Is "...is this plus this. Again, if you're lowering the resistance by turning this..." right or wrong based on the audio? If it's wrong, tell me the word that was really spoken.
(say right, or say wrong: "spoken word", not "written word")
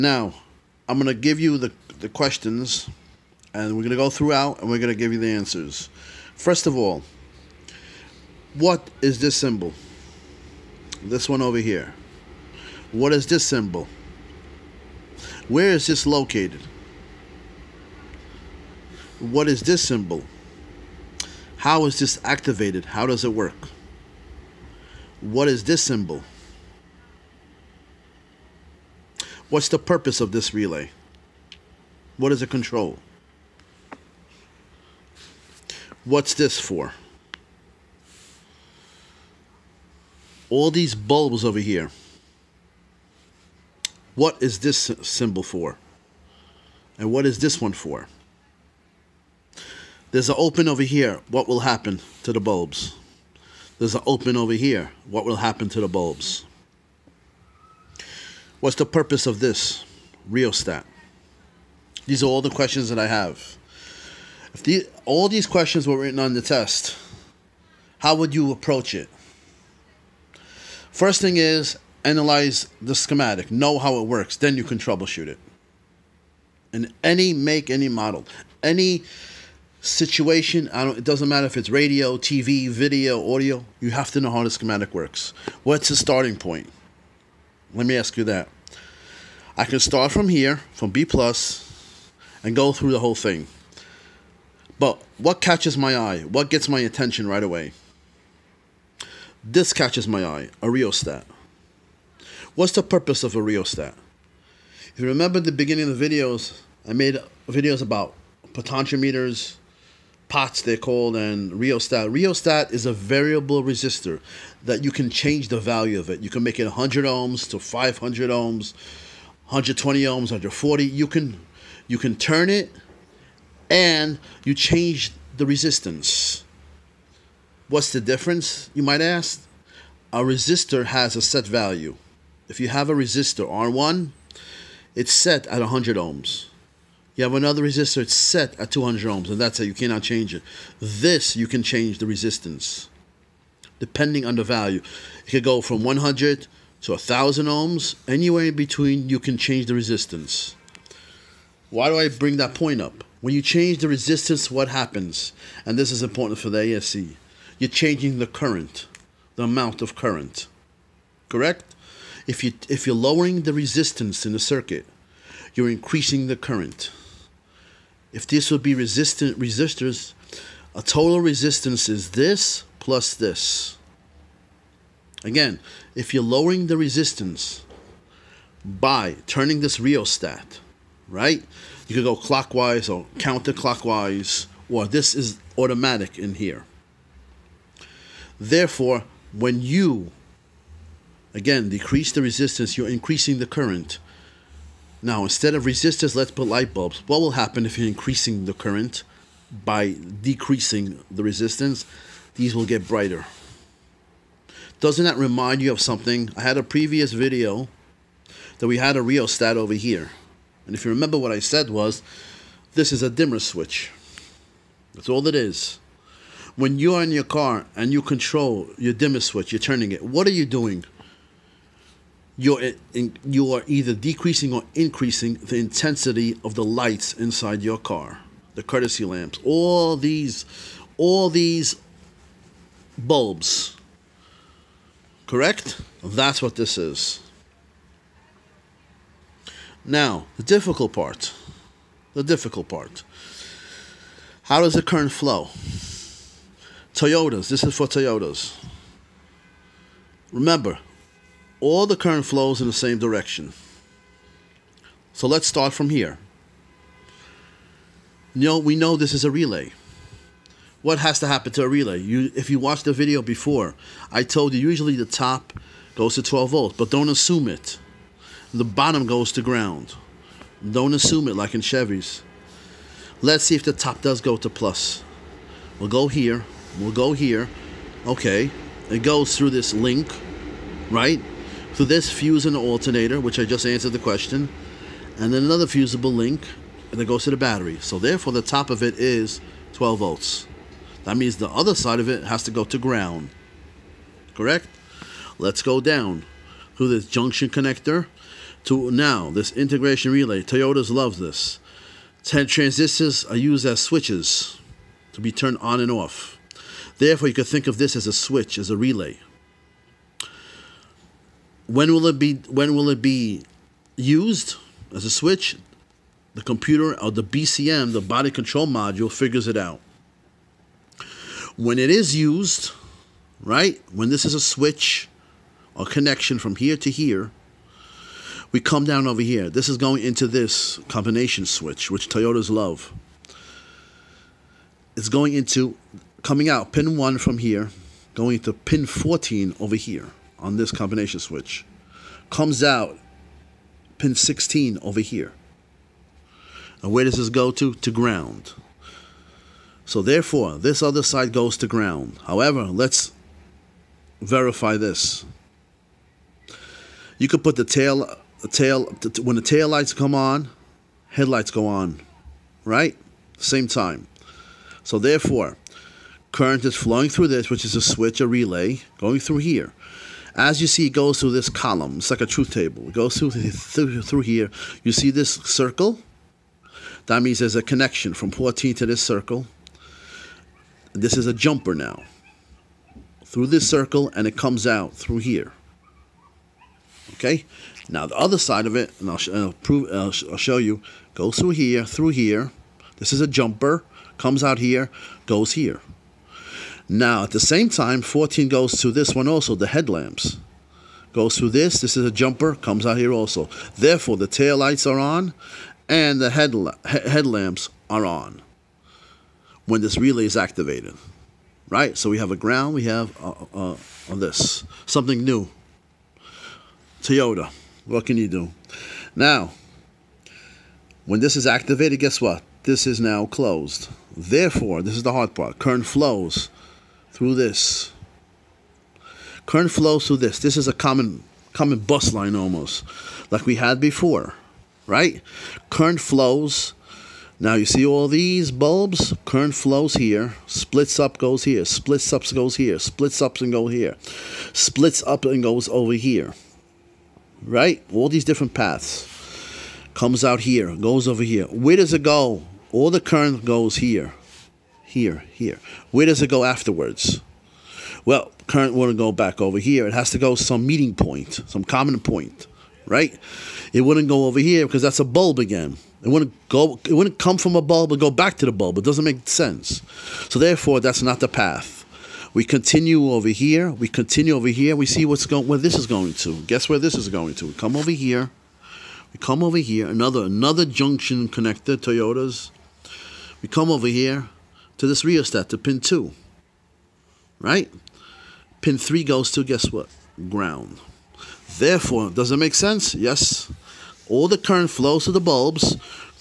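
right.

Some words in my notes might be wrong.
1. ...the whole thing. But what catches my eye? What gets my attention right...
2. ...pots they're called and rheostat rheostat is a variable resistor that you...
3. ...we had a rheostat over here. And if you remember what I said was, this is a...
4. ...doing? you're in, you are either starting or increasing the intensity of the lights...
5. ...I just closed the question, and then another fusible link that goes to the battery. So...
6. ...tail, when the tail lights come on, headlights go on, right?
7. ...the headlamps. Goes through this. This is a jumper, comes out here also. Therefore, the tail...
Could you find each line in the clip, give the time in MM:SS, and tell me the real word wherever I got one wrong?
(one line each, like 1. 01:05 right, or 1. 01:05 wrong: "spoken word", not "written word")
1. 01:32 right
2. 01:50 right
3. 03:28 right
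4. 03:40 wrong: "decreasing", not "starting"
5. 04:43 wrong: "answered", not "closed"
6. 05:58 right
7. 06:39 right.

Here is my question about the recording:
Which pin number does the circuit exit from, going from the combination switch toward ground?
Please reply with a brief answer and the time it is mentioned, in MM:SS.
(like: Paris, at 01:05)
16, at 05:43.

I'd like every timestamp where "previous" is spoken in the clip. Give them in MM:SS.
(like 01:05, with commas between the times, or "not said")
03:26.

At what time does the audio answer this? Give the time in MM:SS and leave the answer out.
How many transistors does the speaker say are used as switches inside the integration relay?
05:02.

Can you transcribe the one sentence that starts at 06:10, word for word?
As you see, it goes through this column.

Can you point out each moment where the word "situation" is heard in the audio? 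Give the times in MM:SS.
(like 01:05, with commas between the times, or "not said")
01:19.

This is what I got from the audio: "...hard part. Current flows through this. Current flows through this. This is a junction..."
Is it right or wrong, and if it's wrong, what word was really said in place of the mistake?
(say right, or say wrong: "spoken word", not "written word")
wrong: "common", not "junction".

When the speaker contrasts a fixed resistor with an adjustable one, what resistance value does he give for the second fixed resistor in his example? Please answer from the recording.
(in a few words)
200 ohms.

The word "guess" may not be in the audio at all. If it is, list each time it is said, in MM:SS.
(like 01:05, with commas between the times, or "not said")
07:01, 07:56, 08:09.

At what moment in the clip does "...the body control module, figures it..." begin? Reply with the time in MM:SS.
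05:17.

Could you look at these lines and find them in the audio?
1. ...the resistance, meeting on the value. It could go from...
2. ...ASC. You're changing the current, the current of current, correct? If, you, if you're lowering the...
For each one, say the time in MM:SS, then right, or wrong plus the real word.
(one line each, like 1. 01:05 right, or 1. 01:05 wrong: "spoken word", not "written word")
1. 02:21 wrong: "depending", not "meeting"
2. 02:36 wrong: "amount", not "current".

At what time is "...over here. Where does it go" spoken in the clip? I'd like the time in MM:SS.
07:31.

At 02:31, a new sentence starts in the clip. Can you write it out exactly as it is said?
Why do I bring that point up?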